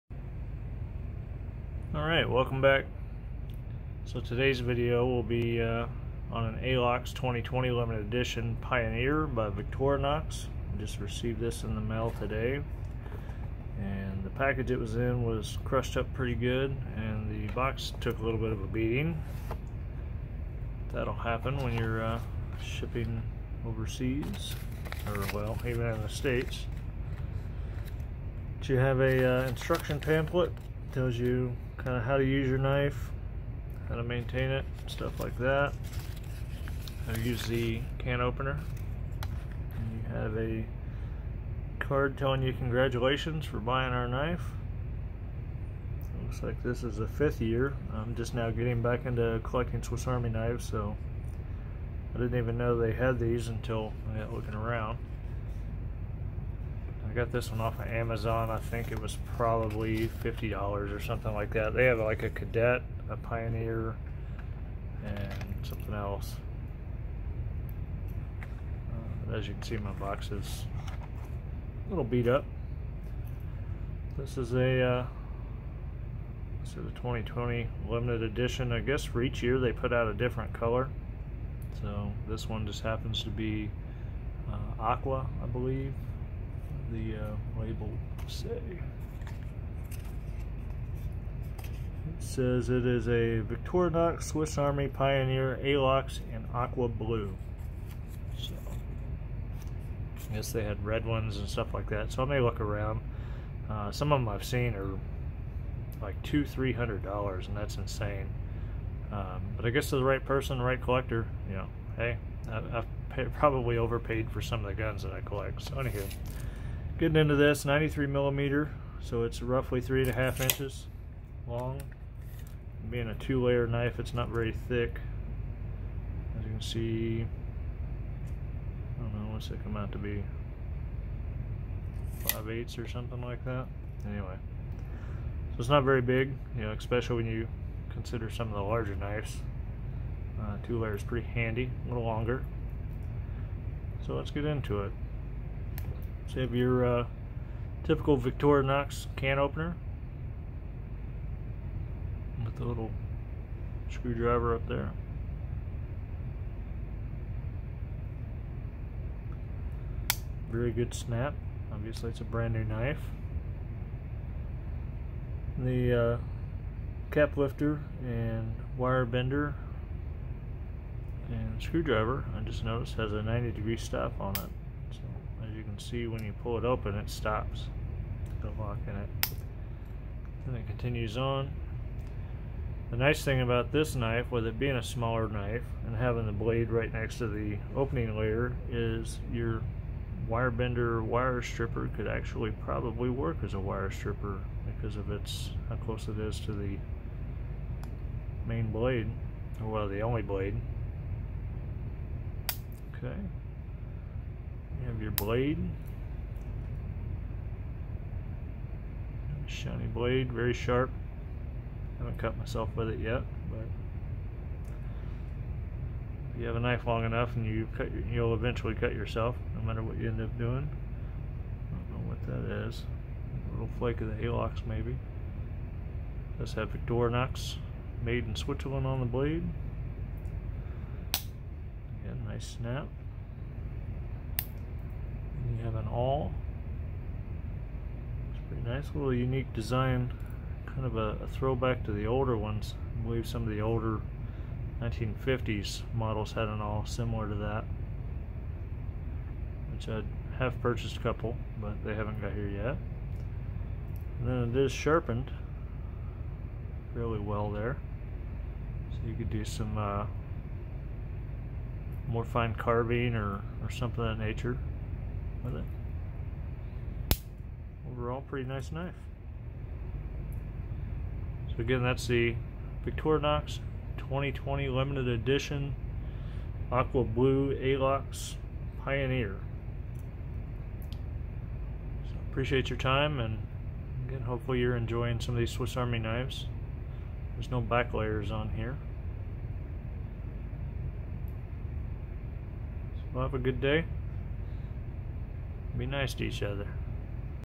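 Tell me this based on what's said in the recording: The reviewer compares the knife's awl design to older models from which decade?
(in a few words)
1950s.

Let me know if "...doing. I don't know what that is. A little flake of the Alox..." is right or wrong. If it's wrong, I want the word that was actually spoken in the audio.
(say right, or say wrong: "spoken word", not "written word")
right.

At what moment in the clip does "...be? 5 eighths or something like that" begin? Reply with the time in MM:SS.
02:09.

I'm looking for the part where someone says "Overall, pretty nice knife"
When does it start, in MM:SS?
04:27.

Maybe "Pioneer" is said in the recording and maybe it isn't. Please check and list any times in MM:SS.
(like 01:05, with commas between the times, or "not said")
00:08, 01:03, 01:34, 04:38.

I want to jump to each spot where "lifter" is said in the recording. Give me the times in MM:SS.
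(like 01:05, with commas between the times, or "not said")
02:47.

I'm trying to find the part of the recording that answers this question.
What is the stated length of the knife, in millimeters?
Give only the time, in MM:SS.
01:57.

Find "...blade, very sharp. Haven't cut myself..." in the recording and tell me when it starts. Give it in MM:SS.
03:29.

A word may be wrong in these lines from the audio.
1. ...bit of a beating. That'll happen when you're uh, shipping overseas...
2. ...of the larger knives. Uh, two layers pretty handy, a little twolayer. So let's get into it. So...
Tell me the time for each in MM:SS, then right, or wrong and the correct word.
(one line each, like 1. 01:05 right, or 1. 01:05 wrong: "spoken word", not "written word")
1. 00:18 right
2. 02:18 wrong: "longer", not "twolayer".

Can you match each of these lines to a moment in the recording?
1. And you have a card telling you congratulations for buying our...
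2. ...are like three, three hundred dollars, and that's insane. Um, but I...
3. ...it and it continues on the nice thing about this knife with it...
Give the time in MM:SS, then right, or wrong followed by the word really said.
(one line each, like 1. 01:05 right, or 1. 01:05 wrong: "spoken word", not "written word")
1. 00:39 right
2. 01:44 wrong: "two", not "three"
3. 02:58 right.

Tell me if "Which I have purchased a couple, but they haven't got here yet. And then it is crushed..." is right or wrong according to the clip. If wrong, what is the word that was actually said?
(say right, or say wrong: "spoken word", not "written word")
wrong: "sharpened", not "crushed".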